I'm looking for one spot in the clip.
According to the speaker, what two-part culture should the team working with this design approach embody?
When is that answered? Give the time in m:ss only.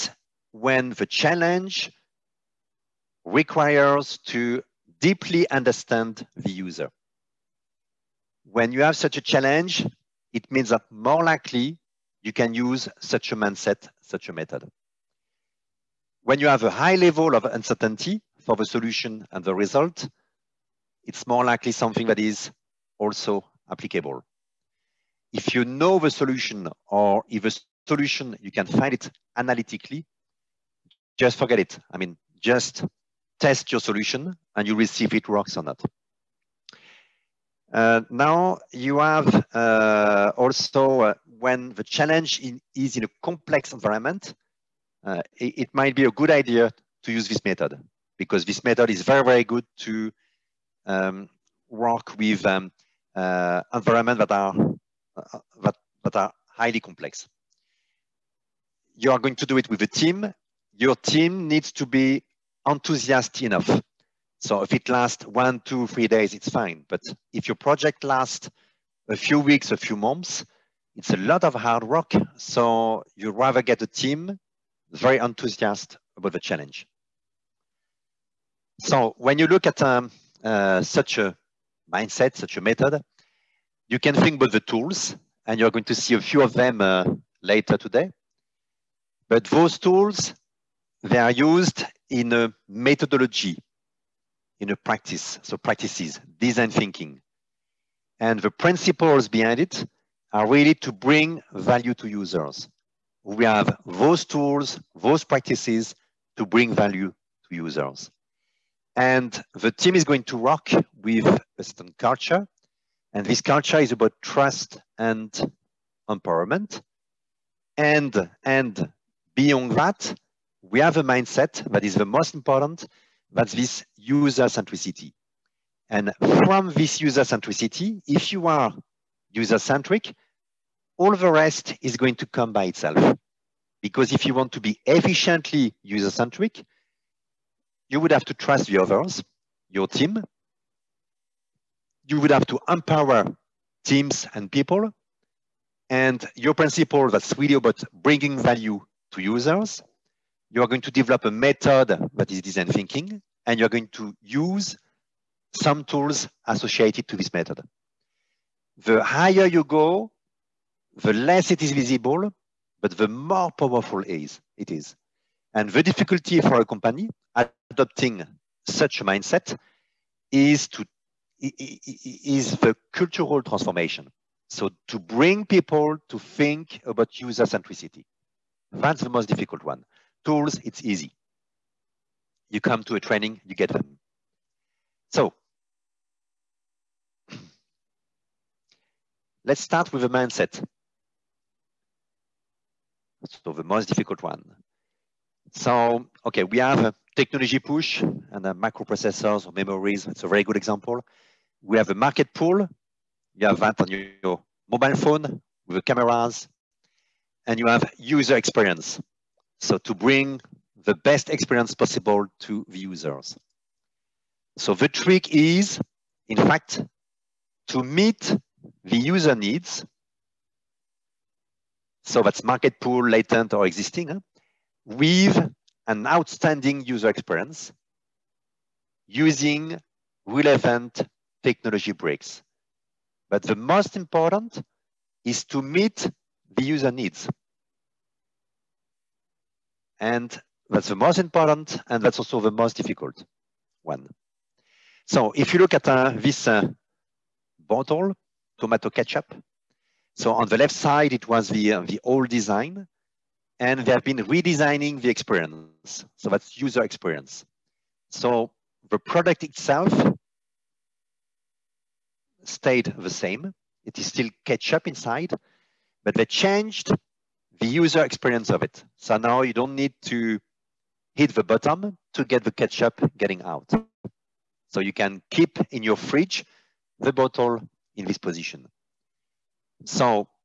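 1:54.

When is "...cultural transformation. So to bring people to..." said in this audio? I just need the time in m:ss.
2:52.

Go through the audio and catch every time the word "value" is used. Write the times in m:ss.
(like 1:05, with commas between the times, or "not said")
1:41, 1:46, 2:28.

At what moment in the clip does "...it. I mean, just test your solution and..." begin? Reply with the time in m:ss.
0:31.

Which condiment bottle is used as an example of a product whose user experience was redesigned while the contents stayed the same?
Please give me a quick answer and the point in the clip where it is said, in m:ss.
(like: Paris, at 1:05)
tomato ketchup, at 4:08.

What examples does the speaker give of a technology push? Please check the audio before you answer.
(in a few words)
microprocessors or memories.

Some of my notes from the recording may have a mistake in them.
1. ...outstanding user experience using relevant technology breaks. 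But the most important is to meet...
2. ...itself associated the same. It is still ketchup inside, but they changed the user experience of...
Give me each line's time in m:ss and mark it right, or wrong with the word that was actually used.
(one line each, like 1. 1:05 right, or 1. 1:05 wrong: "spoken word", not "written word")
1. 3:46 right
2. 4:19 wrong: "stayed", not "associated".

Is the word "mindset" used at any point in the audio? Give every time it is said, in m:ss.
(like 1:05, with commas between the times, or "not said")
0:13, 1:21, 2:01, 2:49, 3:10.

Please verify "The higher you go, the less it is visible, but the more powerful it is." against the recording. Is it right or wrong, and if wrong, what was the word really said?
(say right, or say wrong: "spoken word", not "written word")
right.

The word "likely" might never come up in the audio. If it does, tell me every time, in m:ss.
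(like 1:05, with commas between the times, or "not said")
0:11, 0:21.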